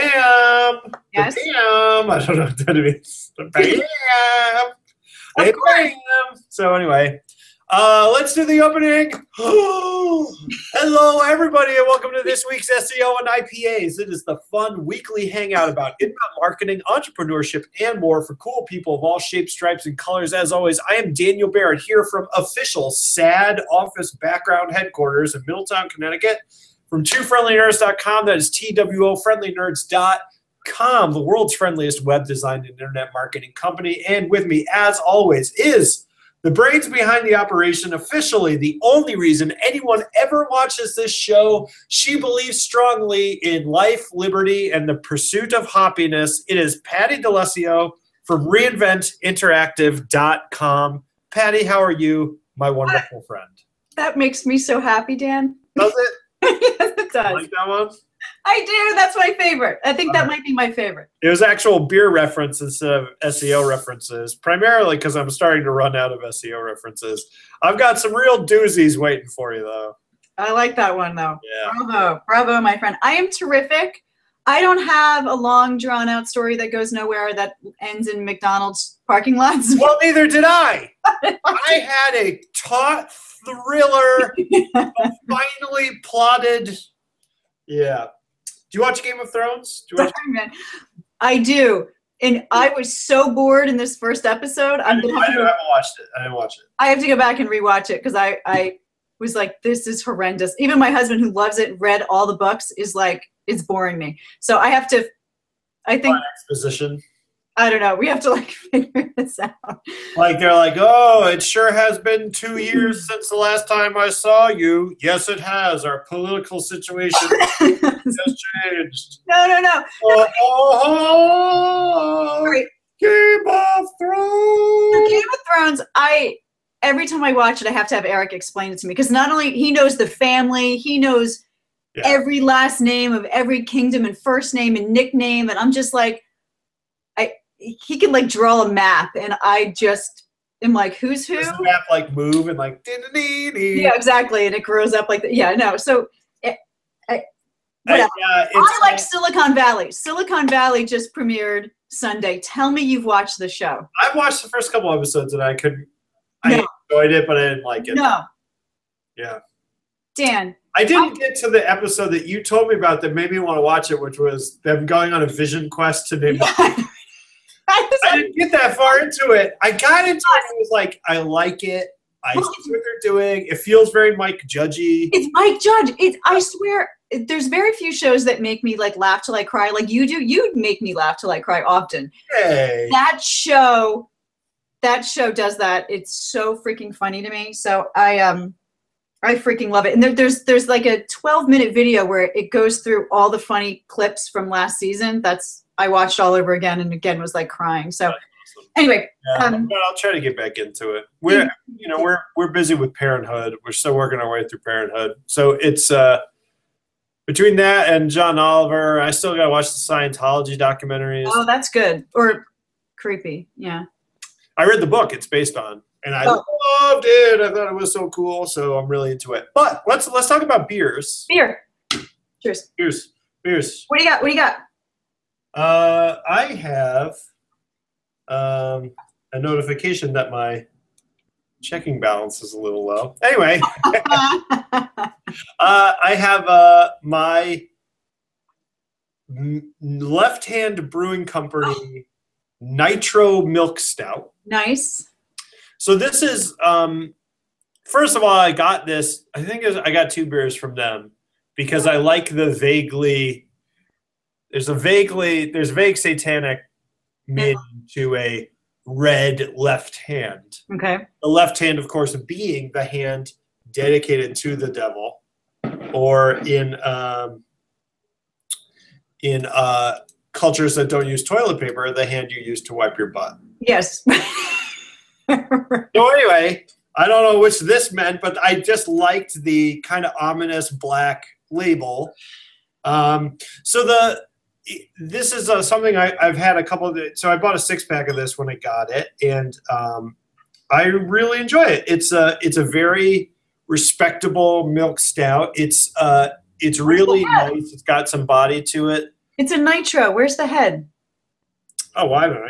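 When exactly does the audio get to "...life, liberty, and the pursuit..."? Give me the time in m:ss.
0:43.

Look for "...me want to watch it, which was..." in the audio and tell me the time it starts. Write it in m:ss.
2:43.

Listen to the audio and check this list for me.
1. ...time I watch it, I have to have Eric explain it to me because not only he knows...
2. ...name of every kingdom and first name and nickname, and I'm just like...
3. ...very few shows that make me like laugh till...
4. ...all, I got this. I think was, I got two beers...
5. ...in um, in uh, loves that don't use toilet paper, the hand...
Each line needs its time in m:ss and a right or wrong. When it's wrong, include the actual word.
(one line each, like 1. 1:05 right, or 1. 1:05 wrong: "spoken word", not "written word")
1. 2:07 right
2. 2:12 right
3. 2:57 right
4. 4:08 right
5. 4:26 wrong: "cultures", not "loves".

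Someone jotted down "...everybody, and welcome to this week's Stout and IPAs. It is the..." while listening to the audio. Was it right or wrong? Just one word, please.
wrong.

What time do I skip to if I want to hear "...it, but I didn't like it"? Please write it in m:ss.
2:37.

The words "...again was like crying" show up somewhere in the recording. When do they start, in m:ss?
3:16.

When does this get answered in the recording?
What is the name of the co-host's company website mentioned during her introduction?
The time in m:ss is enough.
0:48.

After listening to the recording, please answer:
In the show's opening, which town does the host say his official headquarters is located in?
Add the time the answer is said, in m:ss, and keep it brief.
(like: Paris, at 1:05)
Middletown, Connecticut, at 0:25.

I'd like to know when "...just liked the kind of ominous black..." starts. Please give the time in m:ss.
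4:38.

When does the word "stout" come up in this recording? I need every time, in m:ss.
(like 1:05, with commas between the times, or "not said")
4:03, 4:54.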